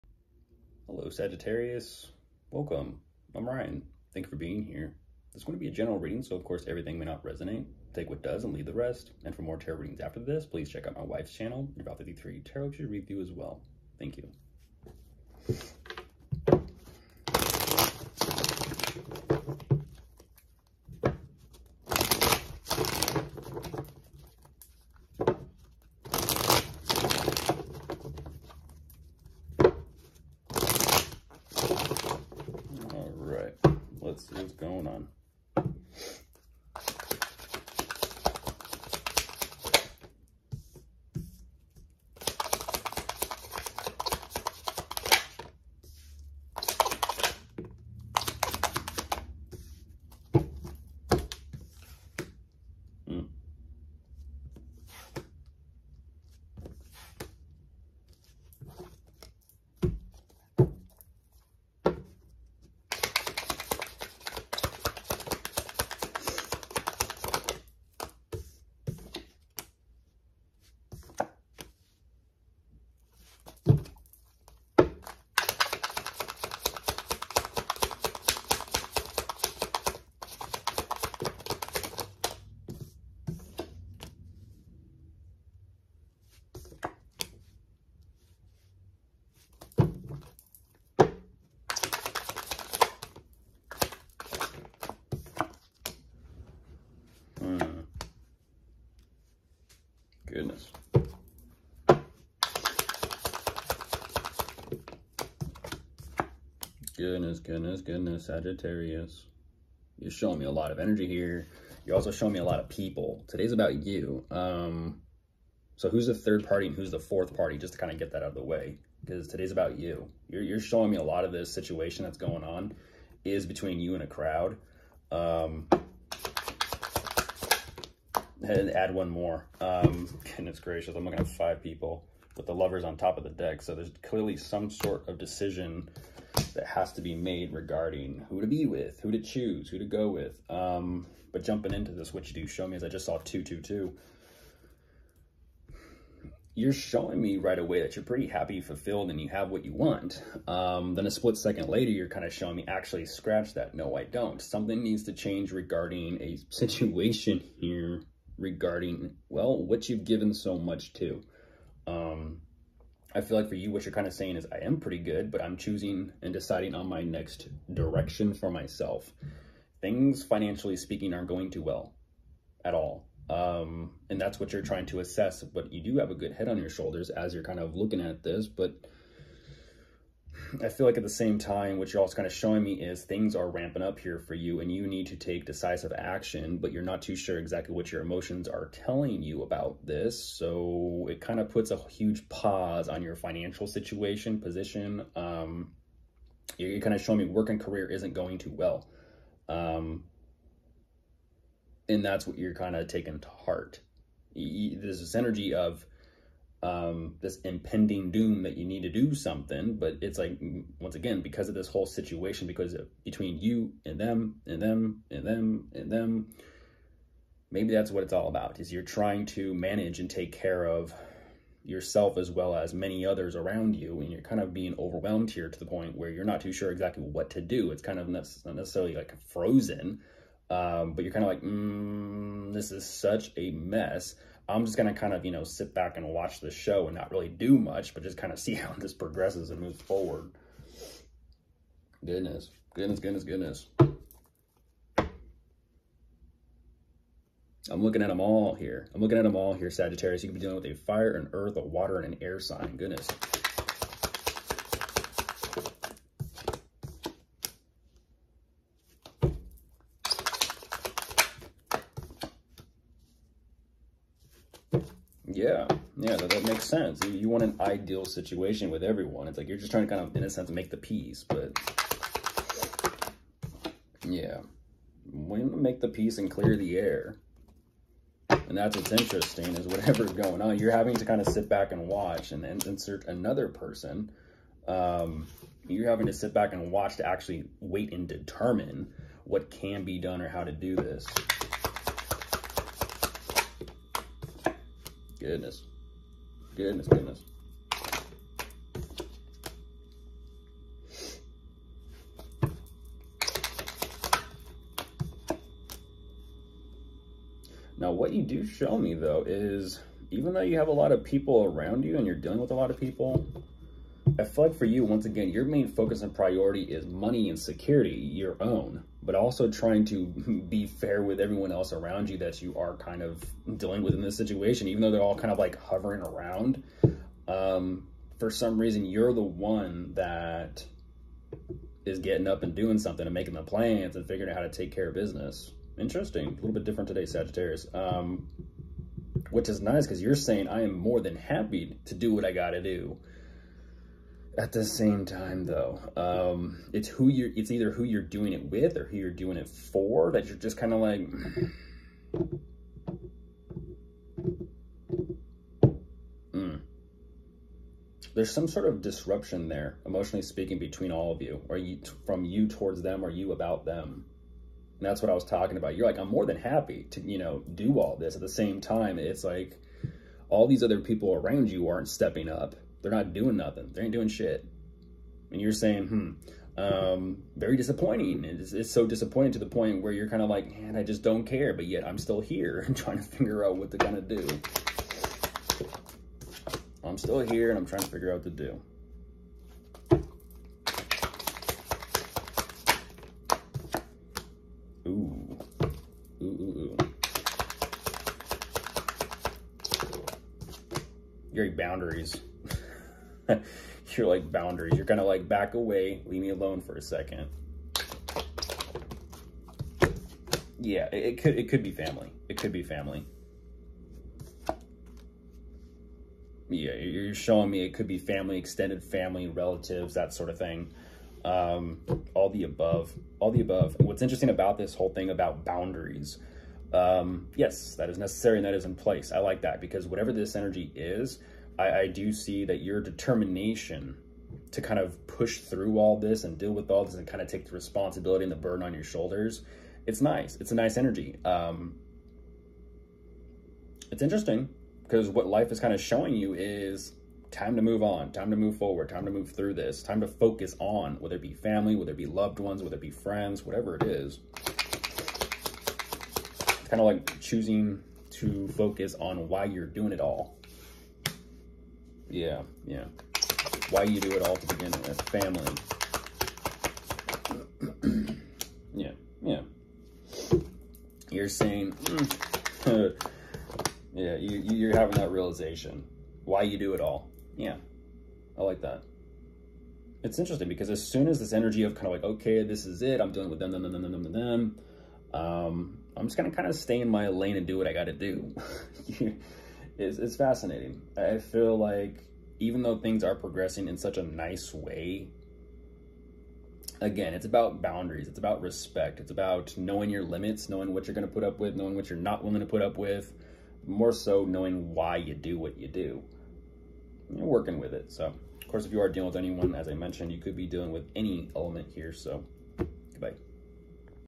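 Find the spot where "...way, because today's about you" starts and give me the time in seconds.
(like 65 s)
118 s.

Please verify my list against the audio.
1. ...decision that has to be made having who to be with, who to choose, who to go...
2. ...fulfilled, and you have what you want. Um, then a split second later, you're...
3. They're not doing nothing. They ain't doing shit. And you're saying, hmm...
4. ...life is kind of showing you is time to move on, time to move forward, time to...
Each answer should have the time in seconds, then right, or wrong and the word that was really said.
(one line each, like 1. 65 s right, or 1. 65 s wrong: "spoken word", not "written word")
1. 135 s wrong: "regarding", not "having"
2. 148 s right
3. 372 s right
4. 445 s right.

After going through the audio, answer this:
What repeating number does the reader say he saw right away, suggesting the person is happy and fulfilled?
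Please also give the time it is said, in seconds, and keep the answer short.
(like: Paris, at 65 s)
222, at 143 s.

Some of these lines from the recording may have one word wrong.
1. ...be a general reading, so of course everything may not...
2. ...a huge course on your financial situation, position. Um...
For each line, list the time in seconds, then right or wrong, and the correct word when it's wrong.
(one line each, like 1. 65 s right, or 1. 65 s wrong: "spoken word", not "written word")
1. 5 s right
2. 191 s wrong: "pause", not "course".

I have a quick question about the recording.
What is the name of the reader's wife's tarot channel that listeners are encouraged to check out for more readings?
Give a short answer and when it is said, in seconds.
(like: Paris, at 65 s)
Val 333 Tarot, at 11 s.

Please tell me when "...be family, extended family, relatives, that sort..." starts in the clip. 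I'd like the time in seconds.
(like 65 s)
417 s.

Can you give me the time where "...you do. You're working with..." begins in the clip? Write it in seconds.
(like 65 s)
505 s.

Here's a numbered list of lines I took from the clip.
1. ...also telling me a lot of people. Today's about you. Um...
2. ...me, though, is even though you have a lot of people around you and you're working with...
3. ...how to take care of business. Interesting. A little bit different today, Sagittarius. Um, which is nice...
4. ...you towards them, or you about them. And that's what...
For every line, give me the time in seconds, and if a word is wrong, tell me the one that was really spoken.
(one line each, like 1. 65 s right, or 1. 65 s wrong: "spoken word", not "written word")
1. 111 s wrong: "showing", not "telling"
2. 308 s wrong: "dealing", not "working"
3. 334 s right
4. 362 s right.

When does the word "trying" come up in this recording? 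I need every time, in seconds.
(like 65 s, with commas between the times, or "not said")
174 s, 218 s, 269 s, 319 s, 382 s, 387 s.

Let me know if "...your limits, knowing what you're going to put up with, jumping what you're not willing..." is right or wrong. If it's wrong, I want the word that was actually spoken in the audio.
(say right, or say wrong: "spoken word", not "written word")
wrong: "knowing", not "jumping".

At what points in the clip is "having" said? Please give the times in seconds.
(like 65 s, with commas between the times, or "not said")
280 s, 285 s, 474 s.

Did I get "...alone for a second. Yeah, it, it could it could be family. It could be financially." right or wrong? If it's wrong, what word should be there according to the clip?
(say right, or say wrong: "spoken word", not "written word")
wrong: "family", not "financially".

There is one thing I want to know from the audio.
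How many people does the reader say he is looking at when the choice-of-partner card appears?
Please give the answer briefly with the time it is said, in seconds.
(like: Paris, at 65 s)
5, at 131 s.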